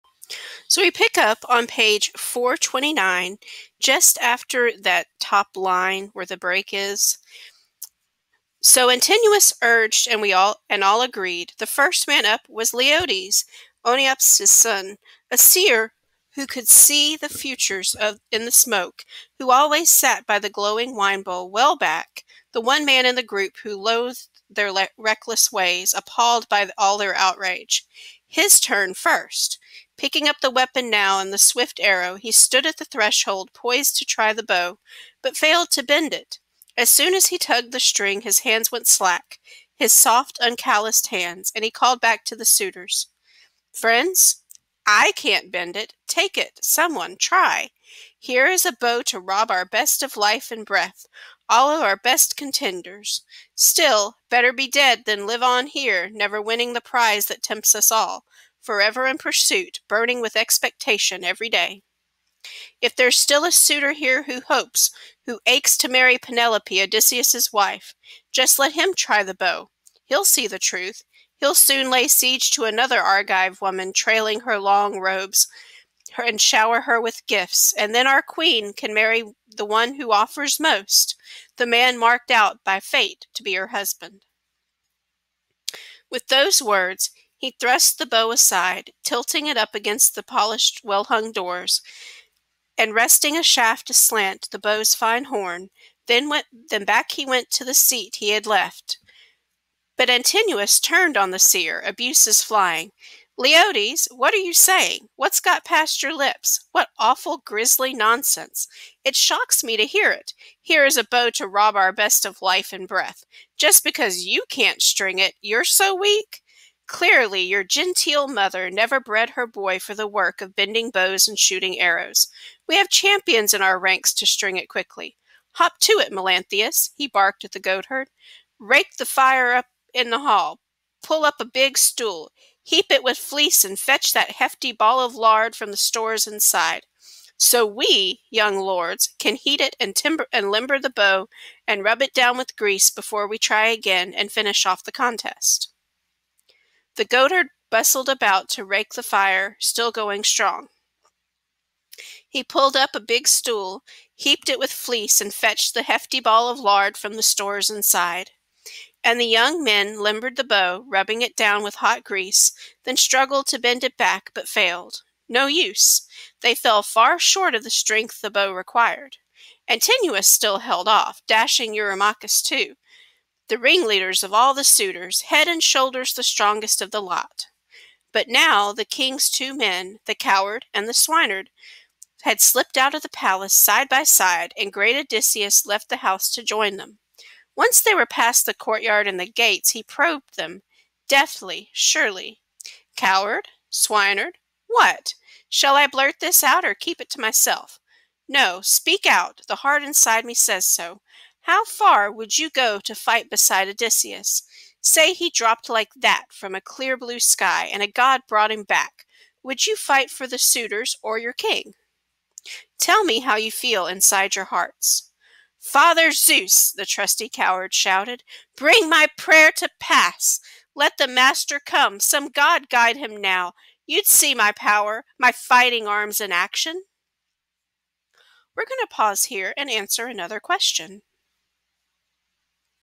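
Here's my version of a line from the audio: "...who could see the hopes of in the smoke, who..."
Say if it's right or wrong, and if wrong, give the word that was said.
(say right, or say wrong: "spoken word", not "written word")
wrong: "futures", not "hopes".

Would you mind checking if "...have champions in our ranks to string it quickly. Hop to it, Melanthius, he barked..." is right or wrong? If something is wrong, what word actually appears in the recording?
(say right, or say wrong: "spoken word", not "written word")
right.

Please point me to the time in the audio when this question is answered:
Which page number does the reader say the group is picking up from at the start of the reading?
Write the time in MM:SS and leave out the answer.
00:01.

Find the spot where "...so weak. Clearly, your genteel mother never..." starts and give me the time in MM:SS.
01:55.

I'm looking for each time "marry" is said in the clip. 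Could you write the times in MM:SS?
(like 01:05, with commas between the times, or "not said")
01:05, 01:18.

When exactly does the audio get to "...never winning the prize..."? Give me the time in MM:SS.
00:56.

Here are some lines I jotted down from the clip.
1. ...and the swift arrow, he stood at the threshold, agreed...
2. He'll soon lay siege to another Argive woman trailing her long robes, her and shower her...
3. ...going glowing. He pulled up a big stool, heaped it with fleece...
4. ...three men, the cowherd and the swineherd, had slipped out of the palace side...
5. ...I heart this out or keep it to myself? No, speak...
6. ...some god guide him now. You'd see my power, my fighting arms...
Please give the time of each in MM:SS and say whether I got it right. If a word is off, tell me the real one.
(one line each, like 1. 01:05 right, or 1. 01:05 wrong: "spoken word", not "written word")
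1. 00:31 wrong: "poised", not "agreed"
2. 01:11 right
3. 02:29 wrong: "strong", not "glowing"
4. 02:59 wrong: "two", not "three"
5. 03:15 wrong: "blurt", not "heart"
6. 03:41 right.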